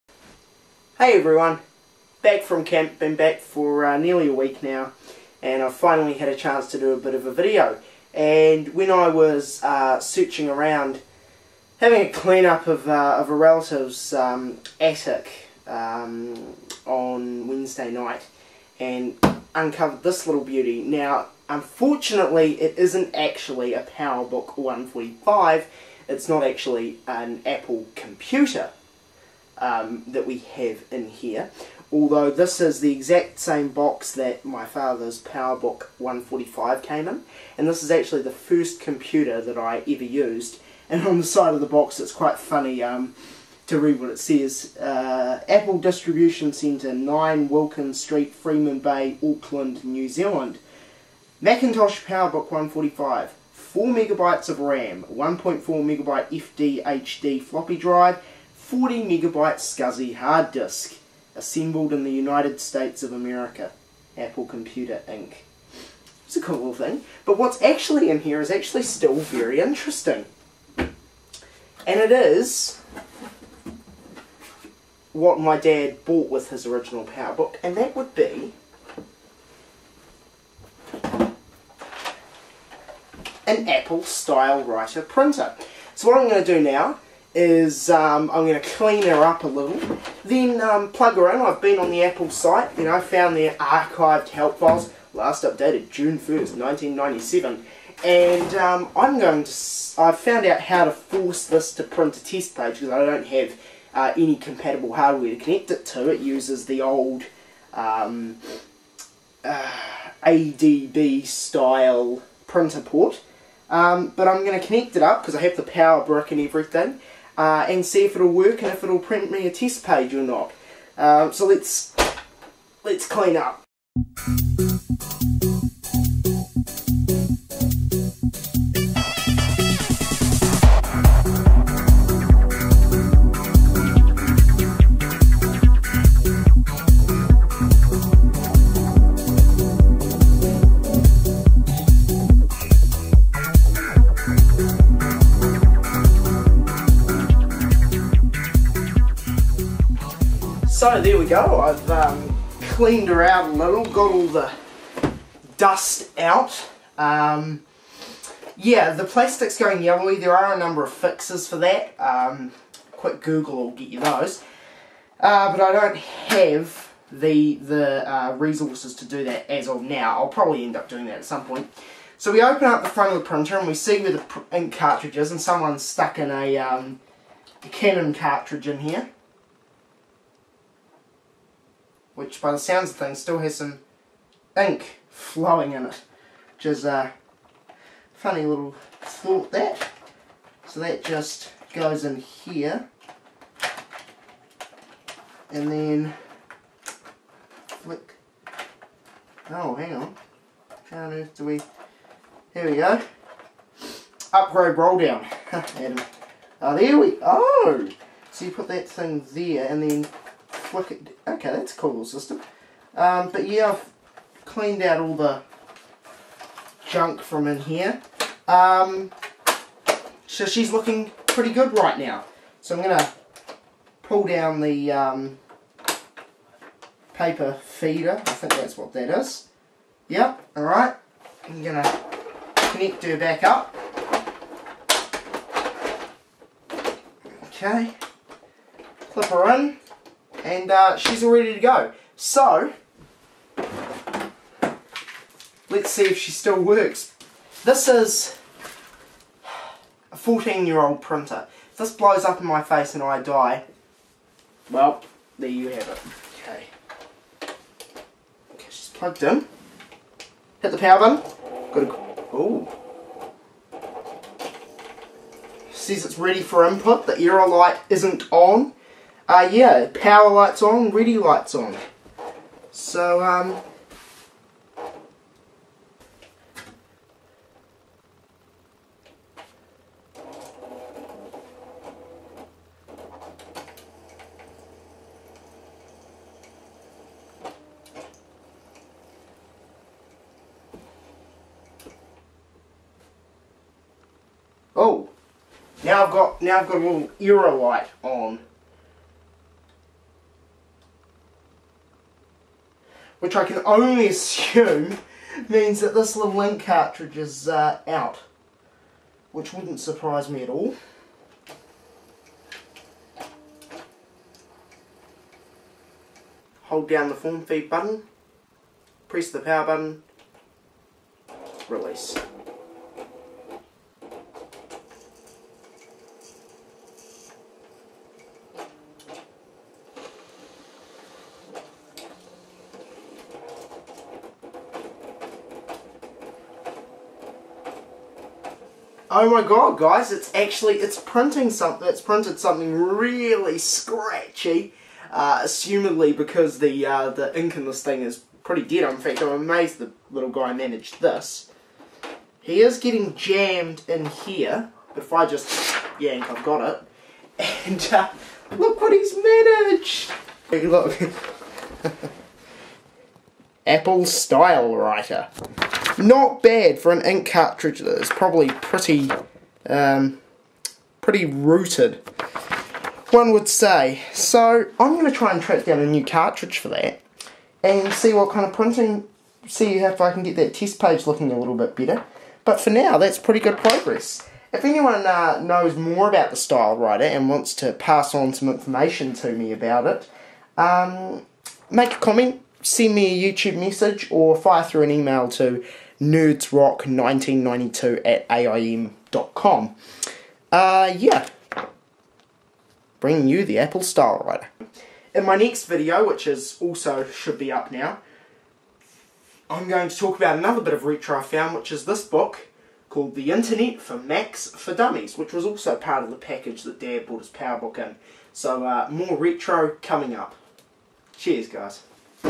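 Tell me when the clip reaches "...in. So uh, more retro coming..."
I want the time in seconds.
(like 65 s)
417 s.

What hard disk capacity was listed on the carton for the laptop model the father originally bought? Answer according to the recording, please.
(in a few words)
40 megabytes.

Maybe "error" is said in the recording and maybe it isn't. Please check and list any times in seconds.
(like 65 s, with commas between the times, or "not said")
267 s.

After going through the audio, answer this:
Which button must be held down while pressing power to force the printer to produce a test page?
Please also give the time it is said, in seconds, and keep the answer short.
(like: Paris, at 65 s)
Form feed, at 317 s.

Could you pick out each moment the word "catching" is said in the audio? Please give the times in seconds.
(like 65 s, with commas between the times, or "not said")
not said.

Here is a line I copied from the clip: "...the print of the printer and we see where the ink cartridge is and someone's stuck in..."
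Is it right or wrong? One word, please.
wrong.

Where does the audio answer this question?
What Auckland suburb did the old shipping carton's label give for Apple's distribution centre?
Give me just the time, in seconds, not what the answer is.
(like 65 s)
48 s.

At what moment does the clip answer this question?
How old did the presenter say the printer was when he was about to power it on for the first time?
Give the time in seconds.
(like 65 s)
250 s.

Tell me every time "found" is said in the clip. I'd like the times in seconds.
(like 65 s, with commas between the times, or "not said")
92 s, 100 s, 411 s.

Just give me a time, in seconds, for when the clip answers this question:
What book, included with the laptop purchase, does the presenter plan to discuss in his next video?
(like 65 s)
413 s.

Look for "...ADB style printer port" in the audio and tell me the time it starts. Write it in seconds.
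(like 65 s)
110 s.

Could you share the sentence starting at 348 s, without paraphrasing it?
In fact, I'm amazed the little guy managed this.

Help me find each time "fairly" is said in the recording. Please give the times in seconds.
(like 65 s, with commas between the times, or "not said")
not said.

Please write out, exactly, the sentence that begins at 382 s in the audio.
But for now, that's pretty good progress.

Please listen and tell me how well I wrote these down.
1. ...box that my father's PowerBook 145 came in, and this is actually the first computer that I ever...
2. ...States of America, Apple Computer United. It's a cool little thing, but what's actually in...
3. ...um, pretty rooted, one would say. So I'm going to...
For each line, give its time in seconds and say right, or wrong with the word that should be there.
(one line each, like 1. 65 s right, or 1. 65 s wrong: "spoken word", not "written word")
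1. 33 s right
2. 62 s wrong: "Inc", not "United"
3. 369 s right.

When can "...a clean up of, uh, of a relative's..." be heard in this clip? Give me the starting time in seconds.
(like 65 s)
12 s.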